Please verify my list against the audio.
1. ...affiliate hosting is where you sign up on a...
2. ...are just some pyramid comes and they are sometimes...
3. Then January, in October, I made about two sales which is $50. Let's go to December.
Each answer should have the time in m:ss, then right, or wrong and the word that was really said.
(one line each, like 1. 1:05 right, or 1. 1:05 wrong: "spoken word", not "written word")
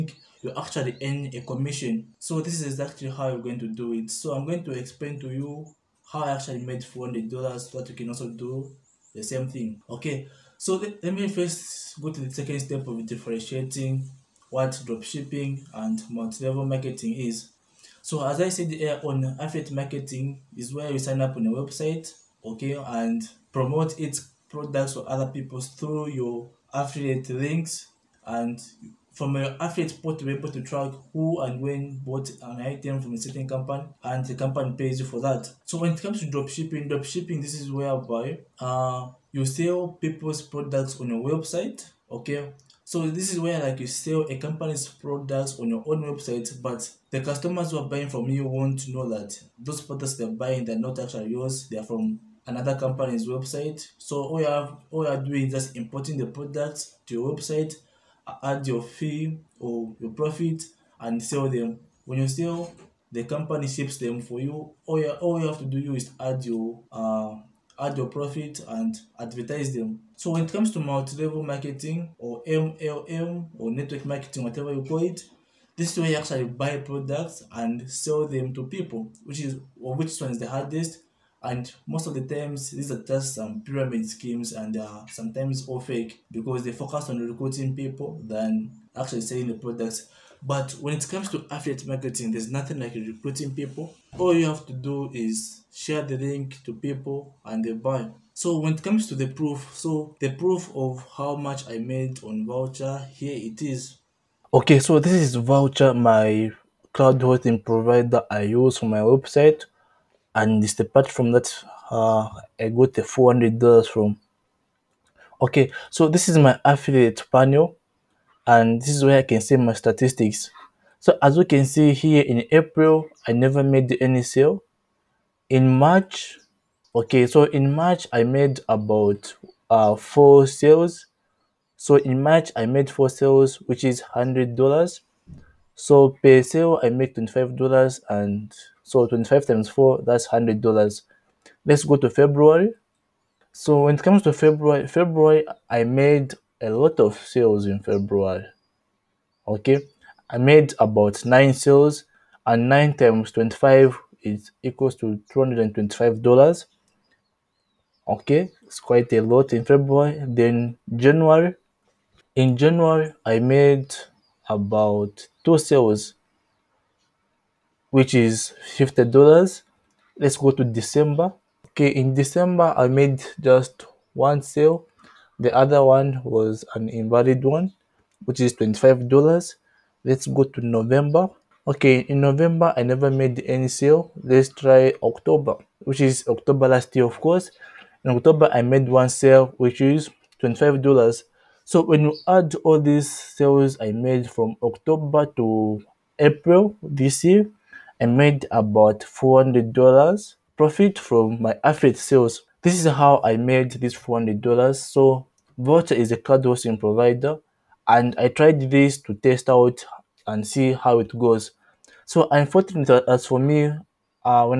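1. 0:19 wrong: "marketing", not "hosting"
2. 1:22 wrong: "schemes", not "comes"
3. 2:40 wrong: "January", not "October".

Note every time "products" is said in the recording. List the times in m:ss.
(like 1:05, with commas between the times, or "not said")
0:24, 0:40, 0:44, 0:49, 0:56, 1:16, 1:29.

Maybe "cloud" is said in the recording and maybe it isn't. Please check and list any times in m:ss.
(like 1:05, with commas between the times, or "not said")
1:46, 3:26.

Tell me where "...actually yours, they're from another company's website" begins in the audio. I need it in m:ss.
0:50.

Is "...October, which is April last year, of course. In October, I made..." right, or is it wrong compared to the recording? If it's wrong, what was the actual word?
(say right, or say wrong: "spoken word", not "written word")
wrong: "October", not "April".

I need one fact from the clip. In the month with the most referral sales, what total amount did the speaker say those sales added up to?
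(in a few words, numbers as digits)
$225.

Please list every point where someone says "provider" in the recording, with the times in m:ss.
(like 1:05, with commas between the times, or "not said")
1:47, 3:26.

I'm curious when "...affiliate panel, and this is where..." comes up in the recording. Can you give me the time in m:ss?
1:56.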